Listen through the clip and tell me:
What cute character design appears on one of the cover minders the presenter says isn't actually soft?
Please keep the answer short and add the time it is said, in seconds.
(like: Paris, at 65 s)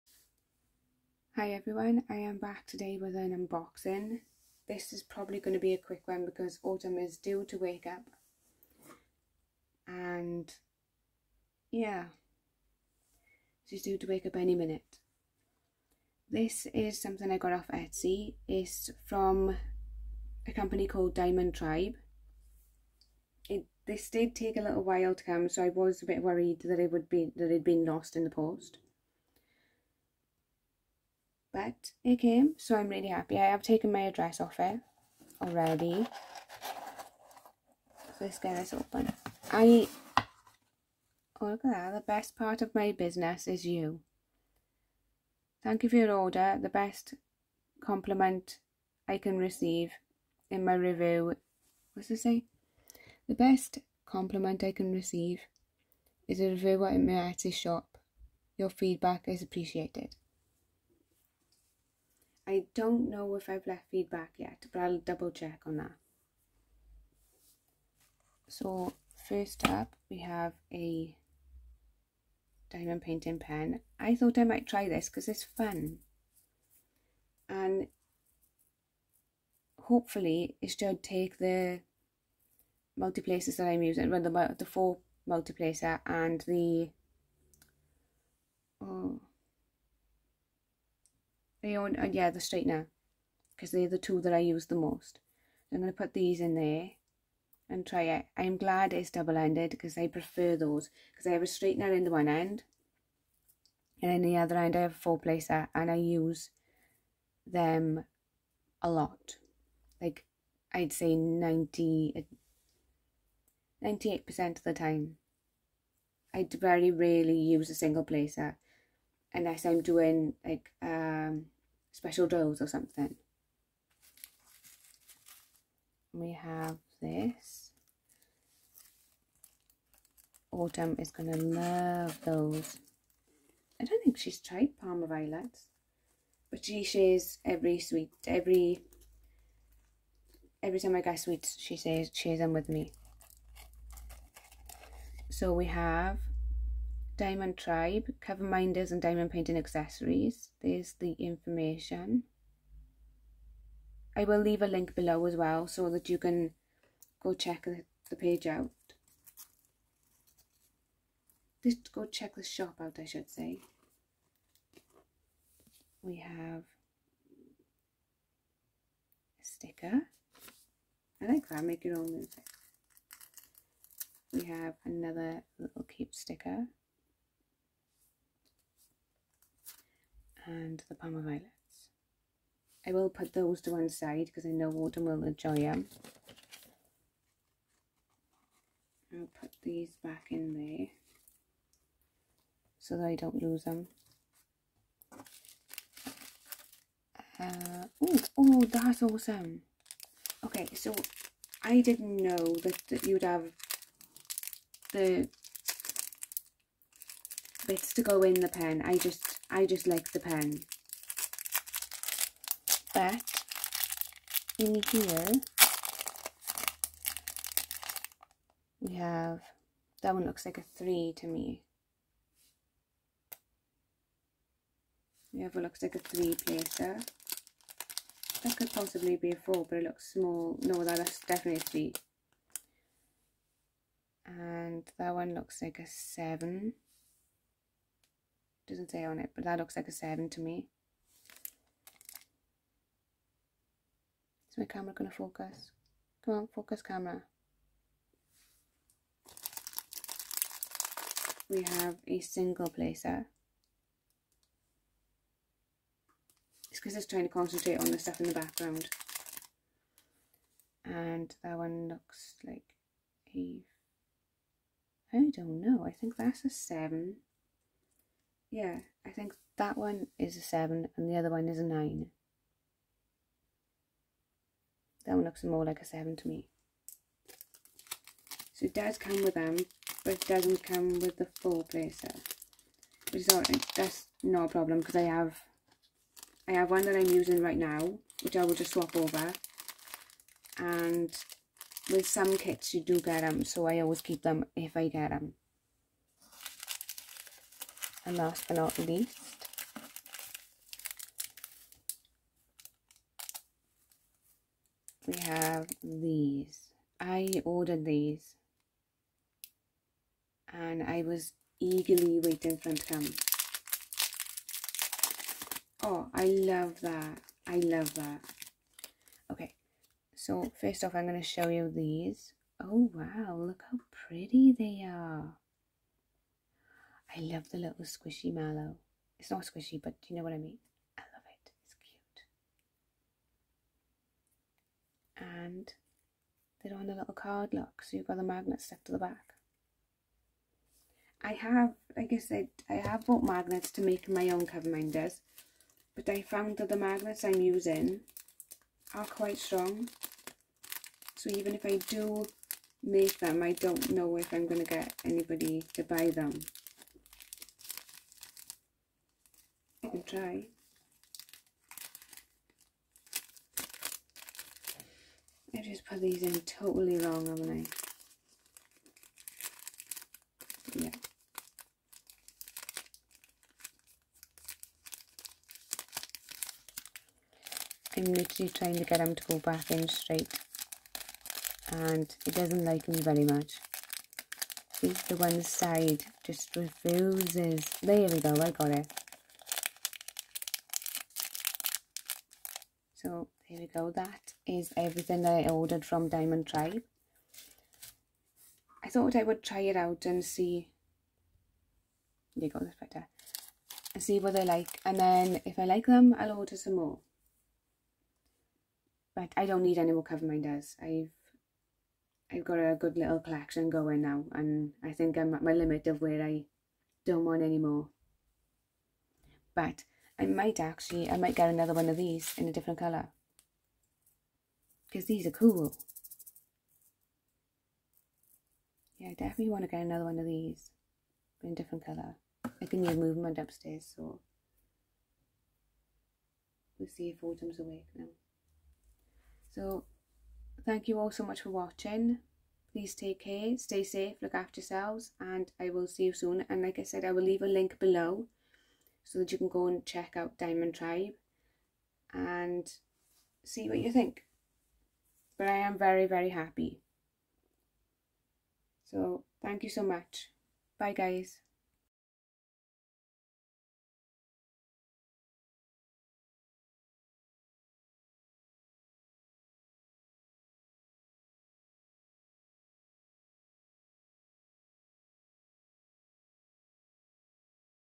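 squishy mallow, at 327 s.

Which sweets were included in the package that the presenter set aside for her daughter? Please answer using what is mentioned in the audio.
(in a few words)
Parma Violets.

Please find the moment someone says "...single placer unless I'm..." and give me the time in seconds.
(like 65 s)
117 s.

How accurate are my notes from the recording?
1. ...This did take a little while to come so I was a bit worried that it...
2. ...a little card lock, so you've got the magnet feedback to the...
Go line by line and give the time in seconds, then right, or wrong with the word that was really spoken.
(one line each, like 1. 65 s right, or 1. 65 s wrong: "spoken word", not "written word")
1. 23 s right
2. 336 s wrong: "stuck", not "feedback".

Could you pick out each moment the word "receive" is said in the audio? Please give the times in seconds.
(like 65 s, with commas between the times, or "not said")
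49 s, 54 s.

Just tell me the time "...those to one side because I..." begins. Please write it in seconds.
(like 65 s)
183 s.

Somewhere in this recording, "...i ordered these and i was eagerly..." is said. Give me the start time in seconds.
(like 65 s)
306 s.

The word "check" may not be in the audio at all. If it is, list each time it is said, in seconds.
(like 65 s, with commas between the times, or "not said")
65 s, 157 s, 162 s, 449 s.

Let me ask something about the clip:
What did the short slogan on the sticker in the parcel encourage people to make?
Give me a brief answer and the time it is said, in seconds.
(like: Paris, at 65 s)
your own music, at 171 s.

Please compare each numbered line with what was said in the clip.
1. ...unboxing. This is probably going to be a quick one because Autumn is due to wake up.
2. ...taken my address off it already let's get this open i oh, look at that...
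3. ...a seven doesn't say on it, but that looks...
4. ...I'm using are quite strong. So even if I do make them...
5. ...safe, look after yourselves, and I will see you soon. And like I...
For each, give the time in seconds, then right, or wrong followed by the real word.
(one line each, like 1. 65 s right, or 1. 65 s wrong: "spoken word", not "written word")
1. 3 s right
2. 33 s right
3. 235 s right
4. 347 s right
5. 443 s right.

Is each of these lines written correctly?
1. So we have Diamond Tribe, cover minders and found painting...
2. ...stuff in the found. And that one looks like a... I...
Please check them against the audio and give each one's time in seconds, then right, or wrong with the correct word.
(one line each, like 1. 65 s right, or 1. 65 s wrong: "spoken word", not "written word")
1. 145 s wrong: "diamond", not "found"
2. 257 s wrong: "background", not "found".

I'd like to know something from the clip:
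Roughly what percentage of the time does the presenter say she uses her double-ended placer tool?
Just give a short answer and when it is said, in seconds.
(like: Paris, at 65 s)
98%, at 113 s.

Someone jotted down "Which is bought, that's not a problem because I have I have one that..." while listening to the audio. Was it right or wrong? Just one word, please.
wrong.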